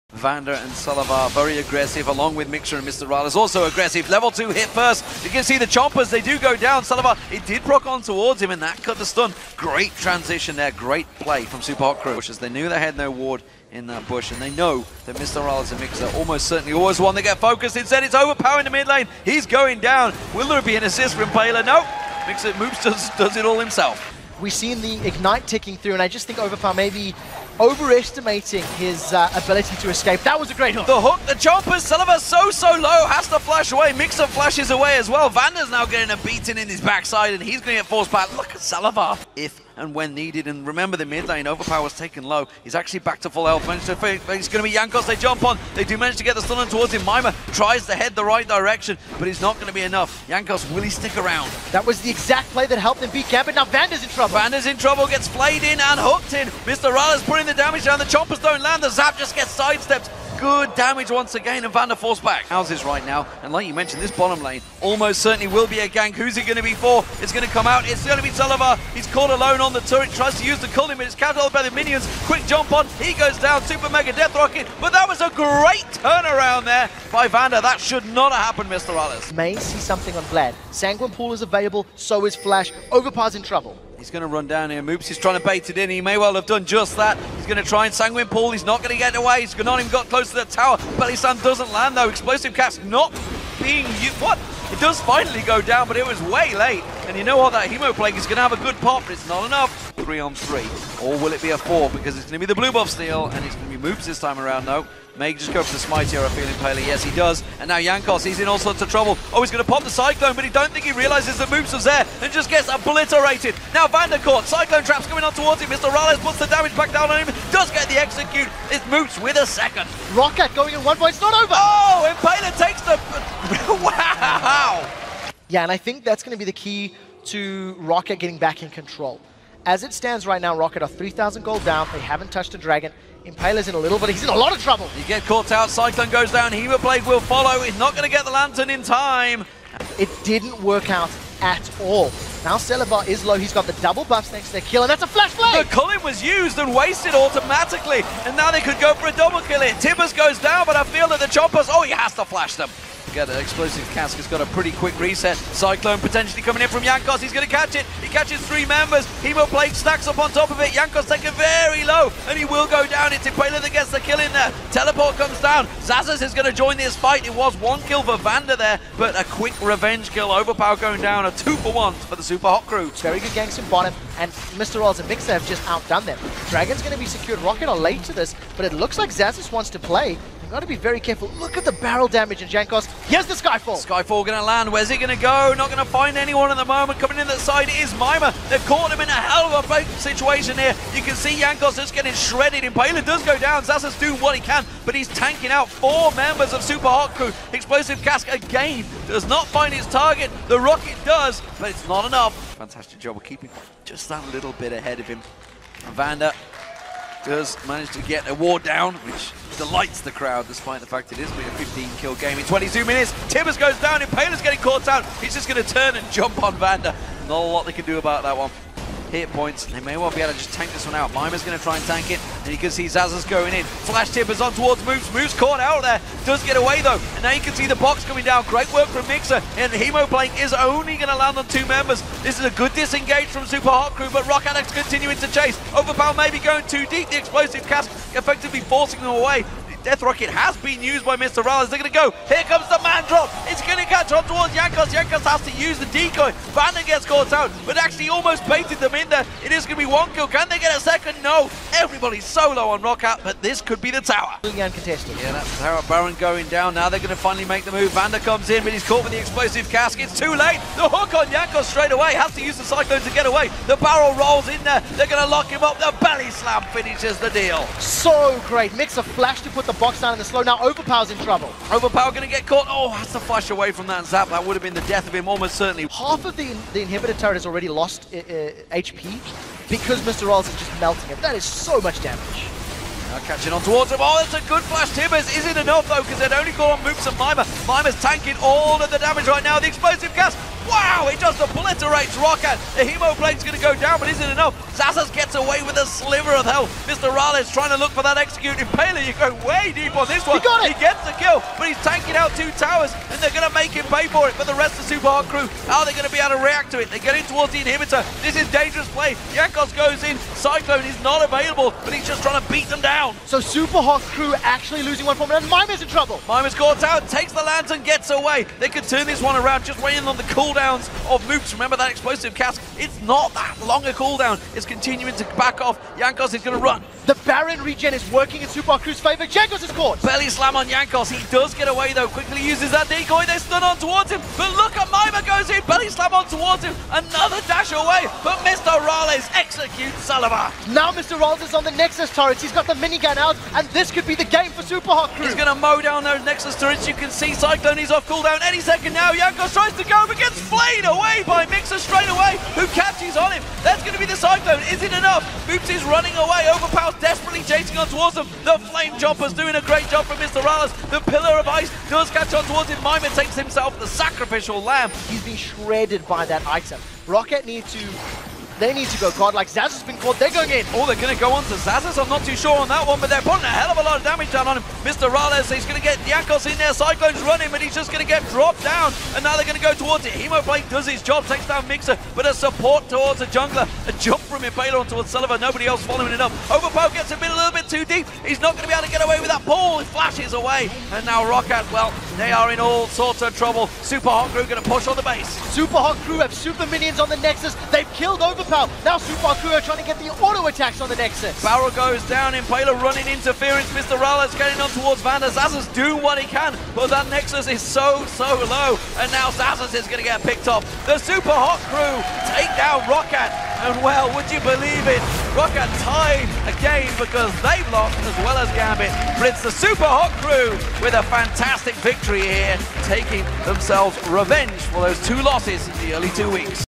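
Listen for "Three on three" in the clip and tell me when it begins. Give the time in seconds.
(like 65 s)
99 s.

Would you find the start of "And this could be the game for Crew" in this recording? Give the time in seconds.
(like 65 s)
343 s.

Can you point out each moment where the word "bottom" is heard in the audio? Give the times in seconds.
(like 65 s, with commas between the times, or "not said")
64 s, 173 s.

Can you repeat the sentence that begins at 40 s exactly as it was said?
And remember, the mid lane Overpow's taken low.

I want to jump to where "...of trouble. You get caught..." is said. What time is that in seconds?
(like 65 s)
134 s.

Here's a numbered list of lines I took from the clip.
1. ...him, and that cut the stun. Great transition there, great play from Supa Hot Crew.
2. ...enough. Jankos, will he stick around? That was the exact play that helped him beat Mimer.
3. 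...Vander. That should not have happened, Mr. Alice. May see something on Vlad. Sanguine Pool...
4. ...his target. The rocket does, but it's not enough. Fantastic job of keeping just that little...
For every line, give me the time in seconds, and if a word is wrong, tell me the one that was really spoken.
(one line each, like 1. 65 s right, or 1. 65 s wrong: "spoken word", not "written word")
1. 8 s right
2. 49 s wrong: "Gambit", not "Mimer"
3. 77 s right
4. 199 s right.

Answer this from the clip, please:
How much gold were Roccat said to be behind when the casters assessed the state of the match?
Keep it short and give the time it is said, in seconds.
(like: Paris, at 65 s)
3,000, at 130 s.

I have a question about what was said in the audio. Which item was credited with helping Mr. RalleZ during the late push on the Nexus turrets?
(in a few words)
Flame Jumper.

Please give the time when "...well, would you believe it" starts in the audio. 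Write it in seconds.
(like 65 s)
413 s.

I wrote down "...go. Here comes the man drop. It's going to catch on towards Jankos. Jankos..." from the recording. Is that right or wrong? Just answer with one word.
right.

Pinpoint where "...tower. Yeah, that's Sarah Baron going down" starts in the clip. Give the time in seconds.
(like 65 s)
254 s.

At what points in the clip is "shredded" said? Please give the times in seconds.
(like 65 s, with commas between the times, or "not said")
192 s, 365 s.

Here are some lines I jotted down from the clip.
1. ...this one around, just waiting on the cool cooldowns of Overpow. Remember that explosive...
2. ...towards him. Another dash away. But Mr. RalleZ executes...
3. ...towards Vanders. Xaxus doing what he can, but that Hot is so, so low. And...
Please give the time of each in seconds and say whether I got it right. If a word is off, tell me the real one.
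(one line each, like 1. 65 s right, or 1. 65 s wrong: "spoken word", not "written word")
1. 319 s wrong: "Moopz", not "Overpow"
2. 336 s right
3. 404 s wrong: "Nexus", not "Hot".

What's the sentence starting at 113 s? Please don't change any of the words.
Now Vandercourt, Cyclone traps coming on towards him.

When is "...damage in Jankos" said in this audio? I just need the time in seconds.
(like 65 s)
182 s.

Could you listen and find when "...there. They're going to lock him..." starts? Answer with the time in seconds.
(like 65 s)
264 s.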